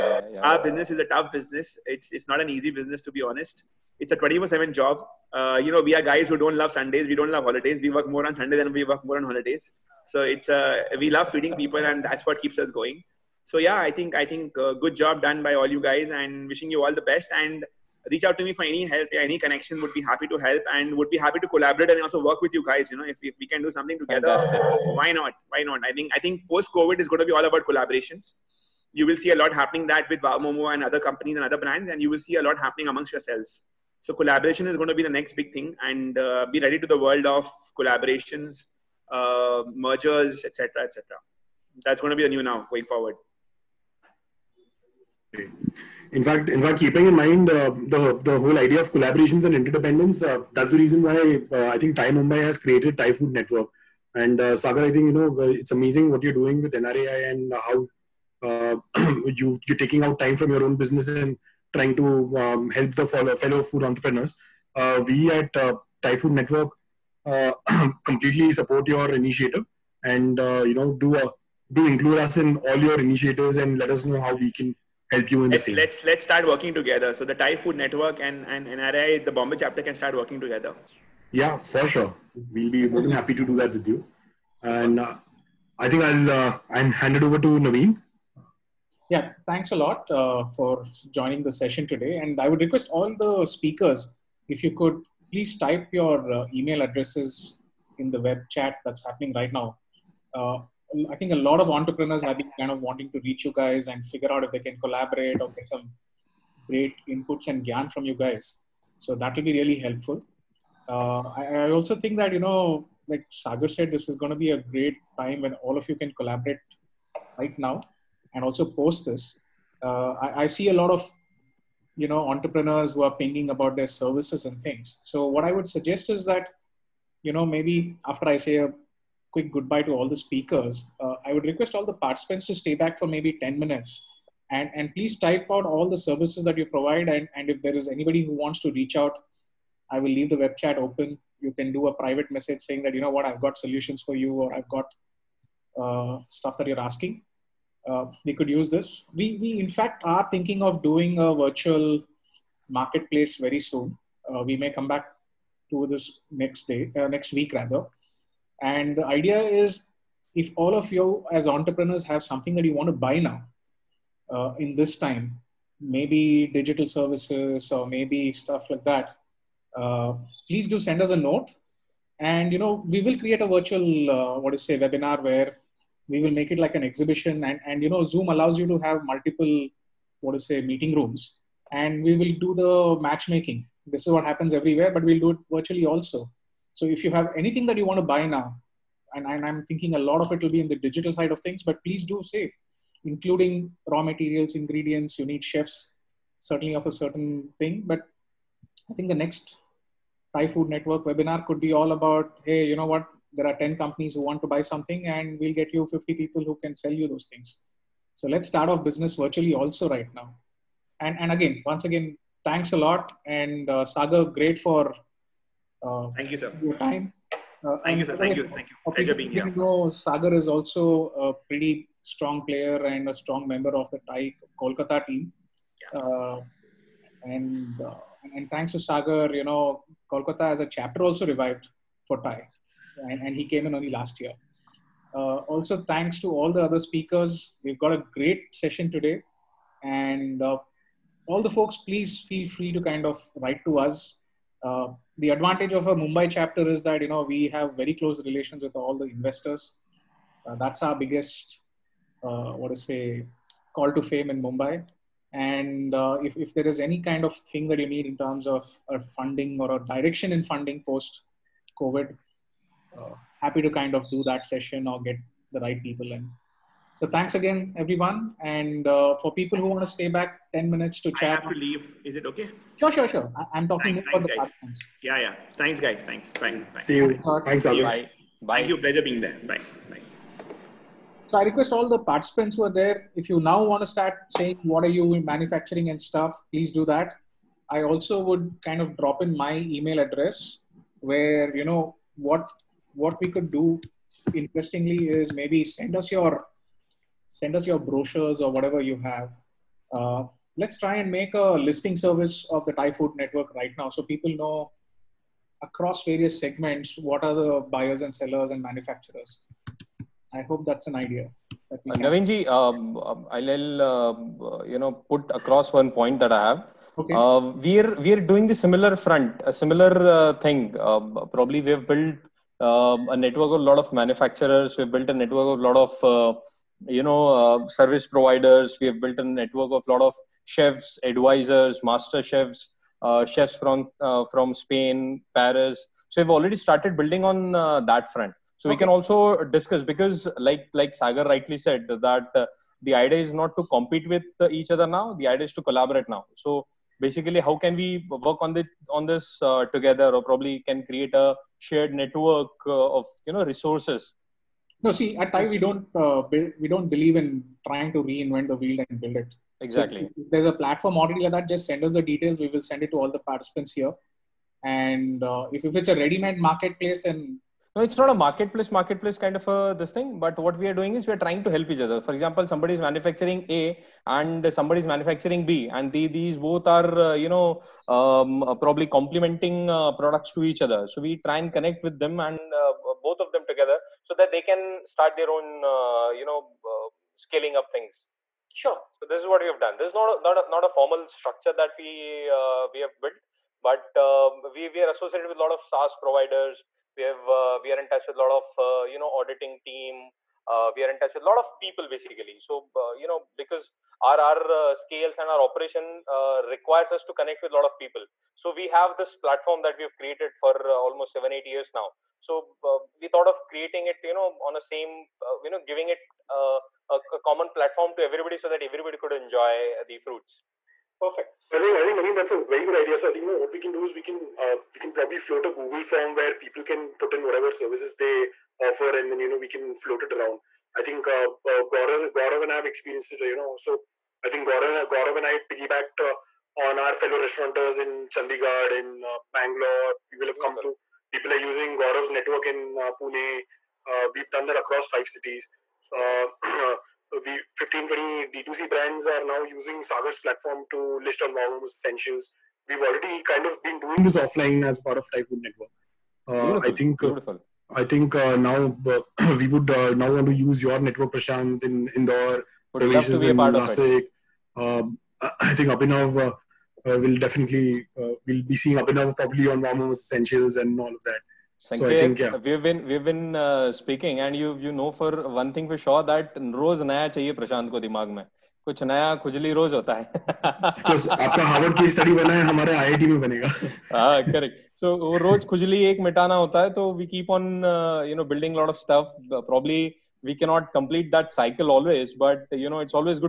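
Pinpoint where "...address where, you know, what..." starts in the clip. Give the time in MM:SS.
04:49.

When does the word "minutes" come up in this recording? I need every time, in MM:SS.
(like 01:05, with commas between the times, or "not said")
02:13, 04:30.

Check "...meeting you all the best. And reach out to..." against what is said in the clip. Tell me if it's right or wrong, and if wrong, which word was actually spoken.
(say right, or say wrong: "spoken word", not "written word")
wrong: "wishing", not "meeting".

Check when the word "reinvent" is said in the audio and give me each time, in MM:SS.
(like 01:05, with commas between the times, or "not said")
05:58.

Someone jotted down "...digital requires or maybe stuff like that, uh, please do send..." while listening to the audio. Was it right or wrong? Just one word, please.
wrong.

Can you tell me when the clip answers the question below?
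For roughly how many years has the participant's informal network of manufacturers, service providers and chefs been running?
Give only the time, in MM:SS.
06:51.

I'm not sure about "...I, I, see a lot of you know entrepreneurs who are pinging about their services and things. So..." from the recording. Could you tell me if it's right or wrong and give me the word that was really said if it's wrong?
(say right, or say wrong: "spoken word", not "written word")
right.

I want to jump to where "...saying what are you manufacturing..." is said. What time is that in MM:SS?
04:44.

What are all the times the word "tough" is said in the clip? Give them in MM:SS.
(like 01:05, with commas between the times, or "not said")
00:01.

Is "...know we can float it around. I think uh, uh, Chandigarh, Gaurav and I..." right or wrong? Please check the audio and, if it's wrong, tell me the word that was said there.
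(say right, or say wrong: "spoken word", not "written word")
wrong: "Gaurav", not "Chandigarh".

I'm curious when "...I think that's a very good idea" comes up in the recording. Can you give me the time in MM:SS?
07:01.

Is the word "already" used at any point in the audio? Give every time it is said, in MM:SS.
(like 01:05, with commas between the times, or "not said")
05:36, 06:01, 07:32.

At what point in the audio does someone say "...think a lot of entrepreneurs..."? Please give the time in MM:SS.
01:41.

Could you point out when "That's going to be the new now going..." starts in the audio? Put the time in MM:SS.
00:41.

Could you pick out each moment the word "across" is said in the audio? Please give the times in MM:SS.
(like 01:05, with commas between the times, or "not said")
05:05, 05:15, 07:24.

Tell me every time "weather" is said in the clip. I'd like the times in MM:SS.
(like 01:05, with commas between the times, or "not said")
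not said.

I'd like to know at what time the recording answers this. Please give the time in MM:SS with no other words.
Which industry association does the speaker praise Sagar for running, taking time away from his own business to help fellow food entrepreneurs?
00:56.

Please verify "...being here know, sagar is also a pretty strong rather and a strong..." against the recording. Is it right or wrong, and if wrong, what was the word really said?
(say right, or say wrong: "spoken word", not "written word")
wrong: "player", not "rather".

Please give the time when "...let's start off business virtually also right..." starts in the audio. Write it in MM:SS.
03:28.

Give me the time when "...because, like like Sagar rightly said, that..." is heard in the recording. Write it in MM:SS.
05:39.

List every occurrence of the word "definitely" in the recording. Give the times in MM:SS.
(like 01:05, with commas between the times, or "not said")
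07:47.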